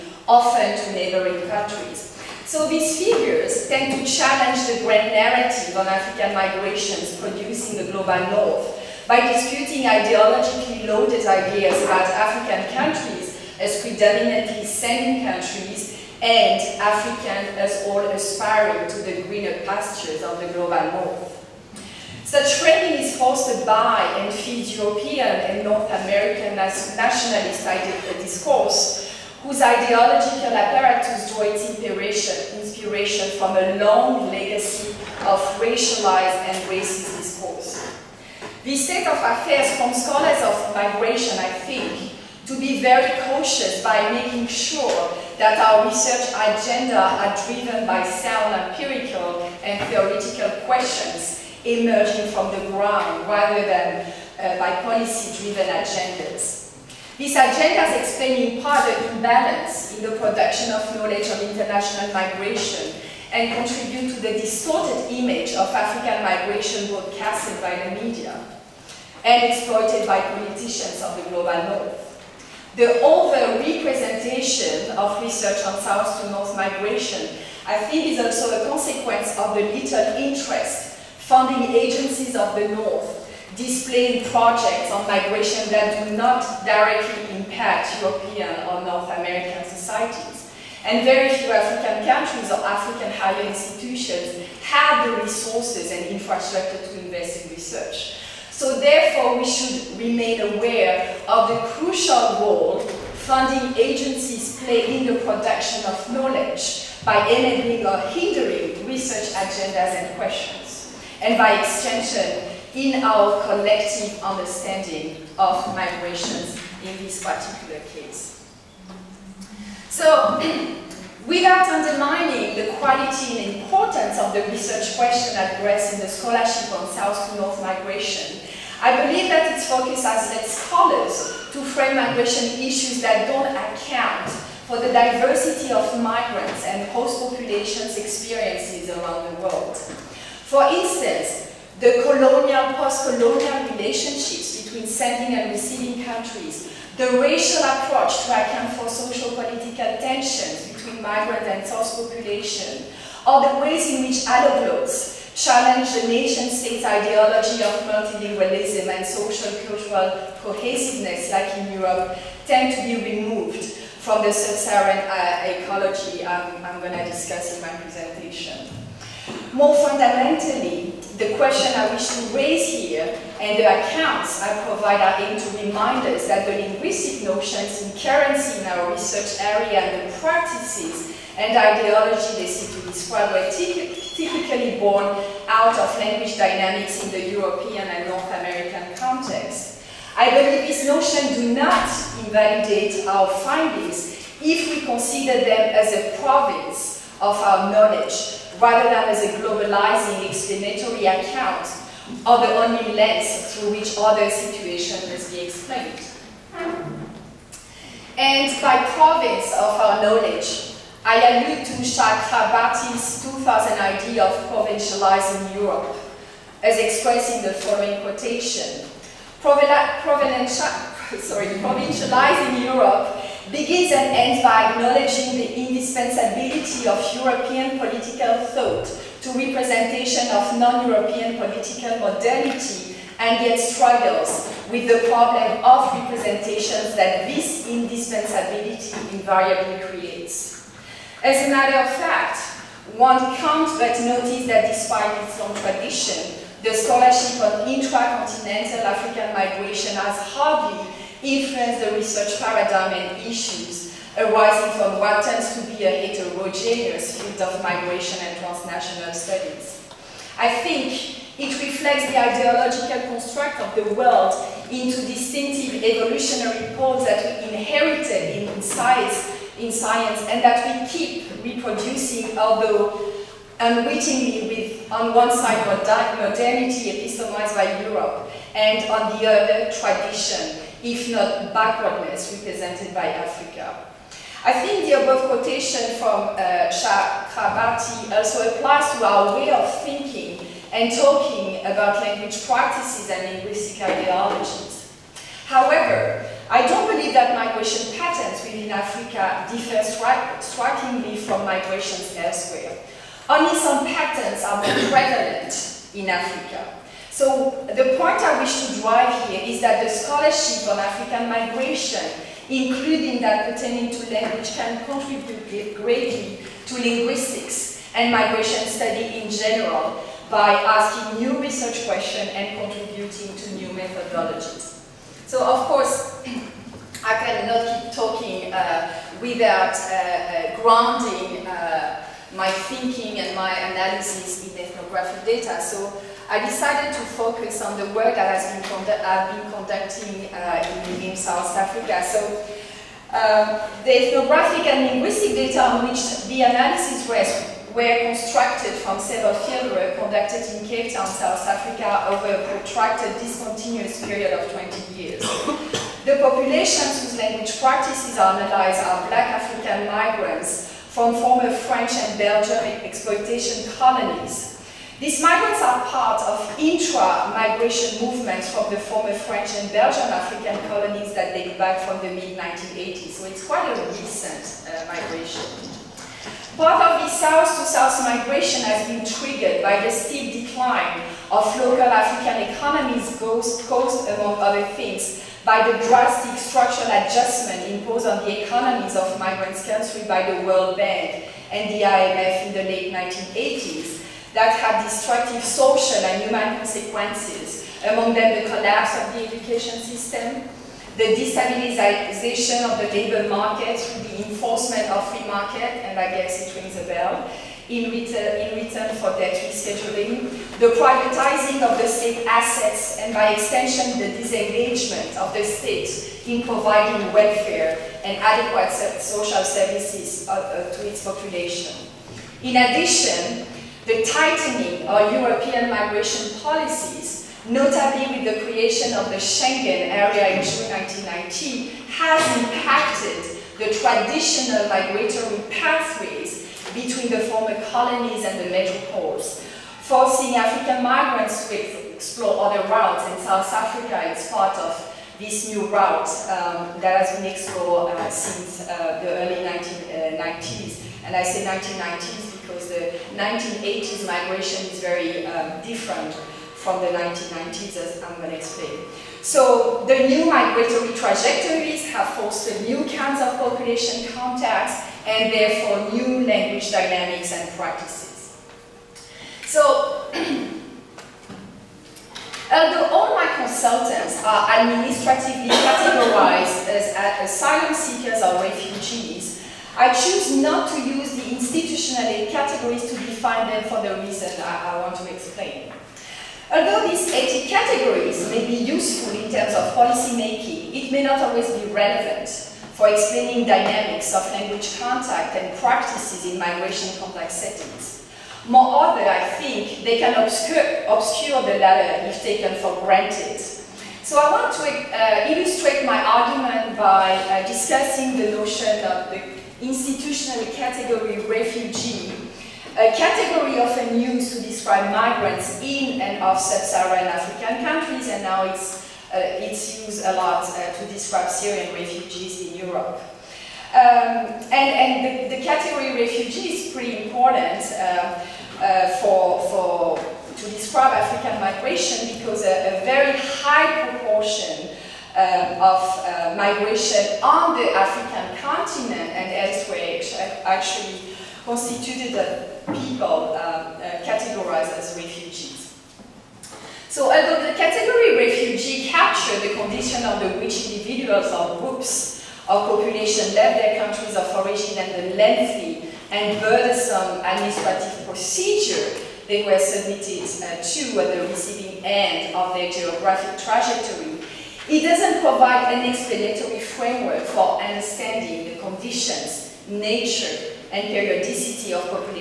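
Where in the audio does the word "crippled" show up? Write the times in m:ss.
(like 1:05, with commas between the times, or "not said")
not said.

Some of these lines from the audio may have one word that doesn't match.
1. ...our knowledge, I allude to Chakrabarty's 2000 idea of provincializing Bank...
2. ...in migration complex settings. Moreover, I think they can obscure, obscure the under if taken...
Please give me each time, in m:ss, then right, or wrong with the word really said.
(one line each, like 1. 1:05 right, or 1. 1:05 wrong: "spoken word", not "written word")
1. 3:29 wrong: "Europe", not "Bank"
2. 8:16 wrong: "latter", not "under".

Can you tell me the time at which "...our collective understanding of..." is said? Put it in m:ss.
1:53.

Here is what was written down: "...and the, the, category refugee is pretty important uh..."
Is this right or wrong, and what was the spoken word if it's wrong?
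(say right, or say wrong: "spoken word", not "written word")
right.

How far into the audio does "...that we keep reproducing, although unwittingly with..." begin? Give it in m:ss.
4:30.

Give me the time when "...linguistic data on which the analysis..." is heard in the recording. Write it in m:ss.
5:44.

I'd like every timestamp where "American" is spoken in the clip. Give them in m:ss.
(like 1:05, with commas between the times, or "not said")
0:26, 1:29, 3:08.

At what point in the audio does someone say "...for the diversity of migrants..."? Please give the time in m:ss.
2:14.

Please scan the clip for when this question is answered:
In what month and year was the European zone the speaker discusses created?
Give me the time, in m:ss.
7:10.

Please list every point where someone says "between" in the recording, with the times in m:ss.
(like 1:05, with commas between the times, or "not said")
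2:24, 2:30, 7:16.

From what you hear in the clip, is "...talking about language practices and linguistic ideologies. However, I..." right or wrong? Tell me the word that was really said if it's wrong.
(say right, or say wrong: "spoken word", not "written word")
right.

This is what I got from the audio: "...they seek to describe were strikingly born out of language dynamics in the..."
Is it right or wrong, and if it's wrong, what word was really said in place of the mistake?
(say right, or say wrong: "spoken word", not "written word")
wrong: "typically", not "strikingly".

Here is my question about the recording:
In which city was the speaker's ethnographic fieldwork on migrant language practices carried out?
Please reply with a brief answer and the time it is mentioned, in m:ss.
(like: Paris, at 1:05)
Cape Town, at 5:50.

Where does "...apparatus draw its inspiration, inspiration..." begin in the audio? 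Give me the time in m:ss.
0:30.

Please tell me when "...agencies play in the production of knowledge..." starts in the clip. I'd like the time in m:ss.
1:43.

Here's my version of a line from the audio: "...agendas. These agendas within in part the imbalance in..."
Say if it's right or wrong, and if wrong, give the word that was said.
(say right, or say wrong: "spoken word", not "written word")
wrong: "explain", not "within".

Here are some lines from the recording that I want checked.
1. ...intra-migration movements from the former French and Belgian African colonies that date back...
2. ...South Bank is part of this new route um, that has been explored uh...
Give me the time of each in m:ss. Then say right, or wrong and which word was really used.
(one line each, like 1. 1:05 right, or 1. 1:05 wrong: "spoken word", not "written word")
1. 6:06 right
2. 7:23 wrong: "Africa", not "Bank".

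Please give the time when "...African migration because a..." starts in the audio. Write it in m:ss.
8:50.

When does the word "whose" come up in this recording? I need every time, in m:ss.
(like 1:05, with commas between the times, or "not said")
0:29, 5:57.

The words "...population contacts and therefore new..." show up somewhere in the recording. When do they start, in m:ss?
7:43.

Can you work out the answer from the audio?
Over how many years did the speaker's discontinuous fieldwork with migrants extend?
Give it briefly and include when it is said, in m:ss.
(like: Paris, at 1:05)
20 years, at 5:54.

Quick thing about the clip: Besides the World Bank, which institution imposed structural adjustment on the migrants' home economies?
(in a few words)
IMF.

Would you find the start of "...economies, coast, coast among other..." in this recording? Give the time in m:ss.
6:22.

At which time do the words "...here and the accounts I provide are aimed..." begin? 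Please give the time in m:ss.
2:52.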